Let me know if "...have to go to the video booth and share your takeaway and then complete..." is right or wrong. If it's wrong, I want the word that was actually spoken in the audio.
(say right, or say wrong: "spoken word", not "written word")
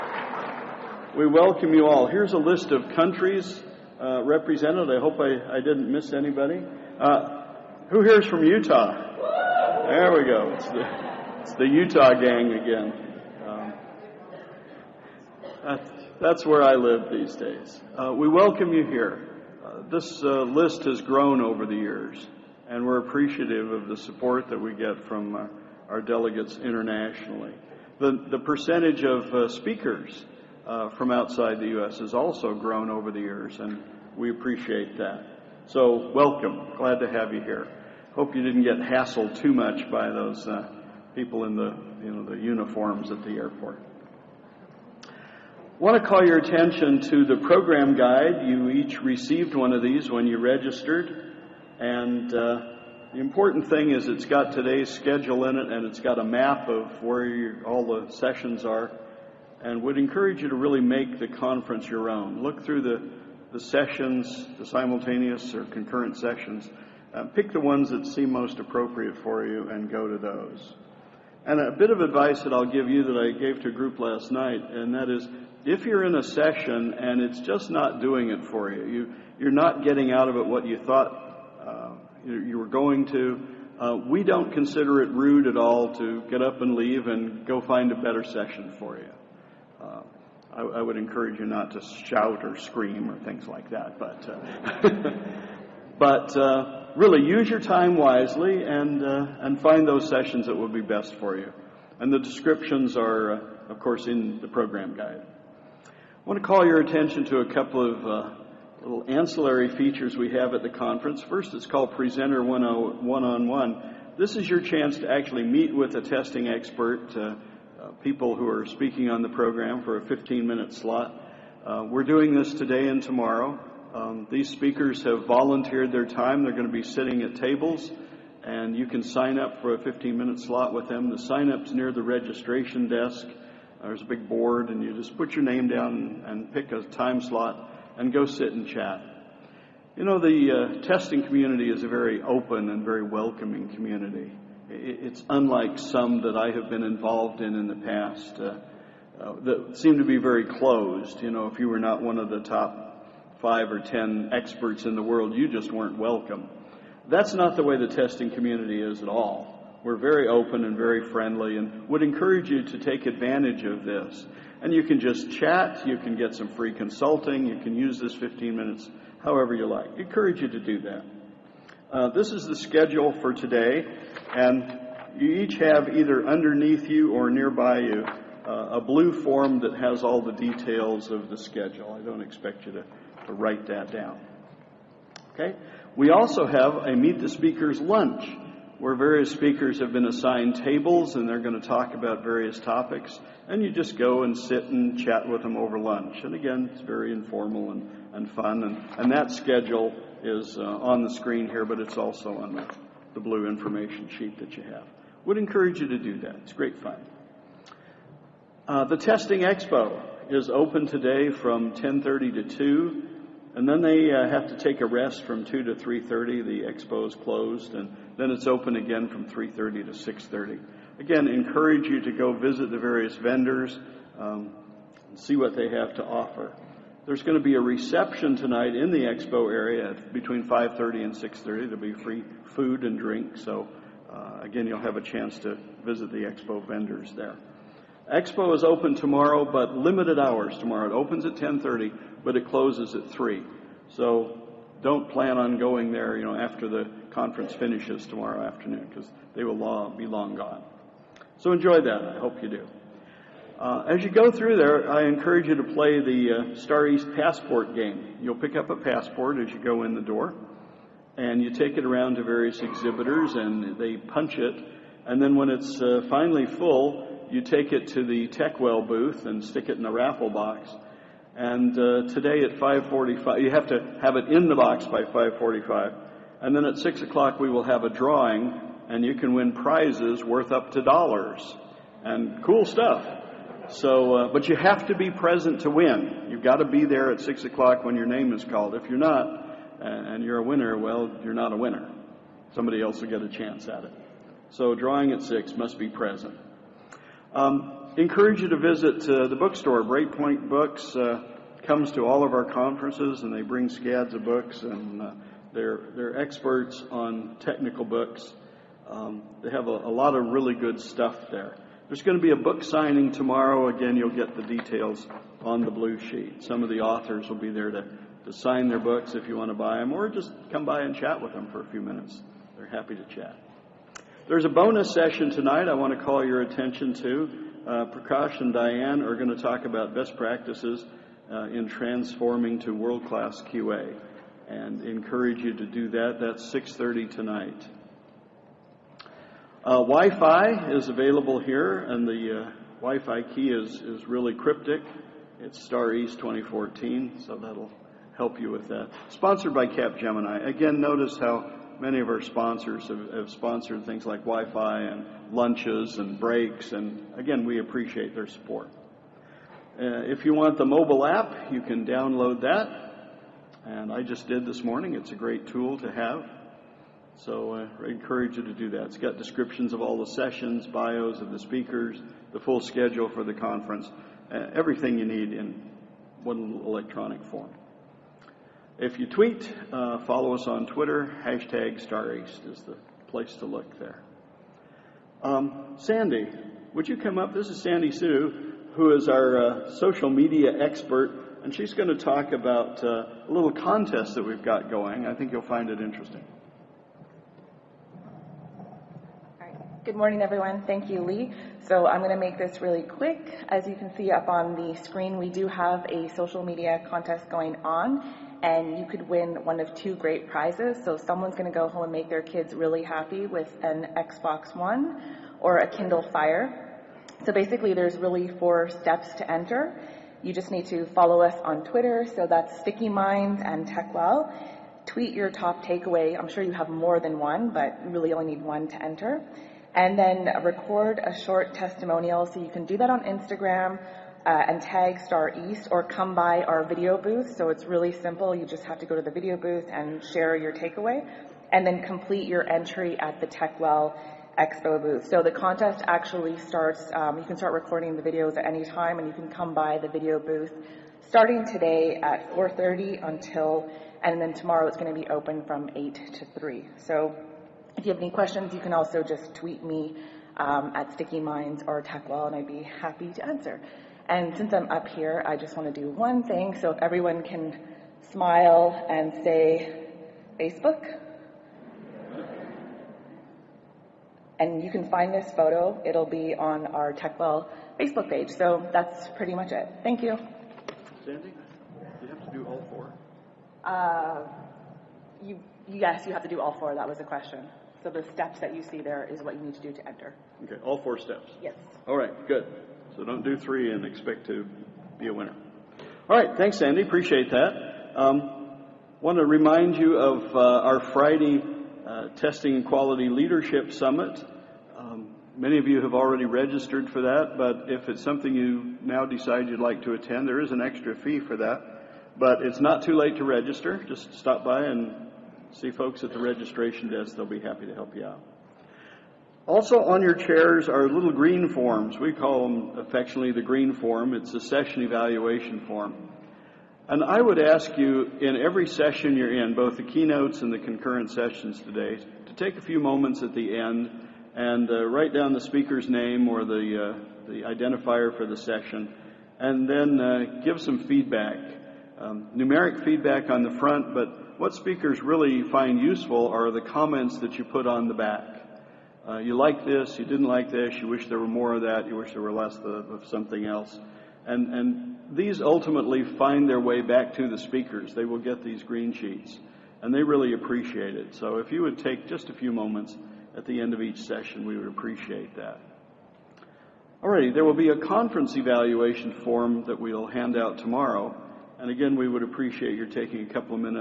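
right.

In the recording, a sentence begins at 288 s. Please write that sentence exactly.
If you're not, and you're a winner, well, you're not a winner.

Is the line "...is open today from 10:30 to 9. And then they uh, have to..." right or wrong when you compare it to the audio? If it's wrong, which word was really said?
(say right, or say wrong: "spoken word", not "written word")
wrong: "2", not "9".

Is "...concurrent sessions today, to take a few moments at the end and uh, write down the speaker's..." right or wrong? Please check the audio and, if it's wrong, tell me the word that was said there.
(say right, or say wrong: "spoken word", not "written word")
right.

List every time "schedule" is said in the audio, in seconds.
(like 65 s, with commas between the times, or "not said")
54 s, 172 s, 181 s, 199 s, 372 s.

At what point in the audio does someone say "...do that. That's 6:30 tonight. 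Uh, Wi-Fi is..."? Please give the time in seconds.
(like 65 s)
335 s.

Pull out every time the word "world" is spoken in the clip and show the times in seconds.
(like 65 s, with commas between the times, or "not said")
155 s, 332 s.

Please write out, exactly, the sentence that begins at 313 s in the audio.
Again, you'll get the details on the blue sheet.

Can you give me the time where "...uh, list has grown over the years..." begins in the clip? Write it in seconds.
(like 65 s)
20 s.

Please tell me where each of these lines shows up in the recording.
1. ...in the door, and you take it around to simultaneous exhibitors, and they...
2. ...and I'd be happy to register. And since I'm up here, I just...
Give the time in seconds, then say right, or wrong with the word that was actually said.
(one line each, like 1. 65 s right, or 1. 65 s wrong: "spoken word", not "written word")
1. 259 s wrong: "various", not "simultaneous"
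2. 462 s wrong: "answer", not "register".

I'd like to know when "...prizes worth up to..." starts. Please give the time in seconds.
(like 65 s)
279 s.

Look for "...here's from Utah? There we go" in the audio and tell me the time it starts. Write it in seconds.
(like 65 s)
8 s.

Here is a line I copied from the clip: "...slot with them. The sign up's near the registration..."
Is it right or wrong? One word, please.
right.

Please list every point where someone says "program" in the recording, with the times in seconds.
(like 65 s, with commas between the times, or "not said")
47 s, 104 s, 119 s.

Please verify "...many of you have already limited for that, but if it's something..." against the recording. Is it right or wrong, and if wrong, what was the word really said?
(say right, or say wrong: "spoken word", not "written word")
wrong: "registered", not "limited".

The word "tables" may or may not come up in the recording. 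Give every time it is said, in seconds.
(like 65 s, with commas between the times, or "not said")
127 s, 190 s.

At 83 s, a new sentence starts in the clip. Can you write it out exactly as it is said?
Uh, we don't consider it rude at all to get up and leave and go find a better session for you.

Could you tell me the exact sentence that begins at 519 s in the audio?
Also on your chairs are little green forms.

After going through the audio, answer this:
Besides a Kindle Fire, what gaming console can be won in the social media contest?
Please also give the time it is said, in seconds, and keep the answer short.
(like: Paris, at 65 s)
Xbox One, at 413 s.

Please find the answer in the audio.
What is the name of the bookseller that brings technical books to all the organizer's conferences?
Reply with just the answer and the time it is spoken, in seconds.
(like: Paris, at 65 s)
Breakpoint Books, at 299 s.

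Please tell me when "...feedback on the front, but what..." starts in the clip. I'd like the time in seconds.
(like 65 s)
542 s.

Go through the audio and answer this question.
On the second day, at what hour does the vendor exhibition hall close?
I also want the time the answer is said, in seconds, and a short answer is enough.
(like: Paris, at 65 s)
3, at 242 s.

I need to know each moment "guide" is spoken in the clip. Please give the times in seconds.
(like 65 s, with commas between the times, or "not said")
47 s, 104 s.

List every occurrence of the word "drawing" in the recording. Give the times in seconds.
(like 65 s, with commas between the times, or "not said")
277 s, 294 s.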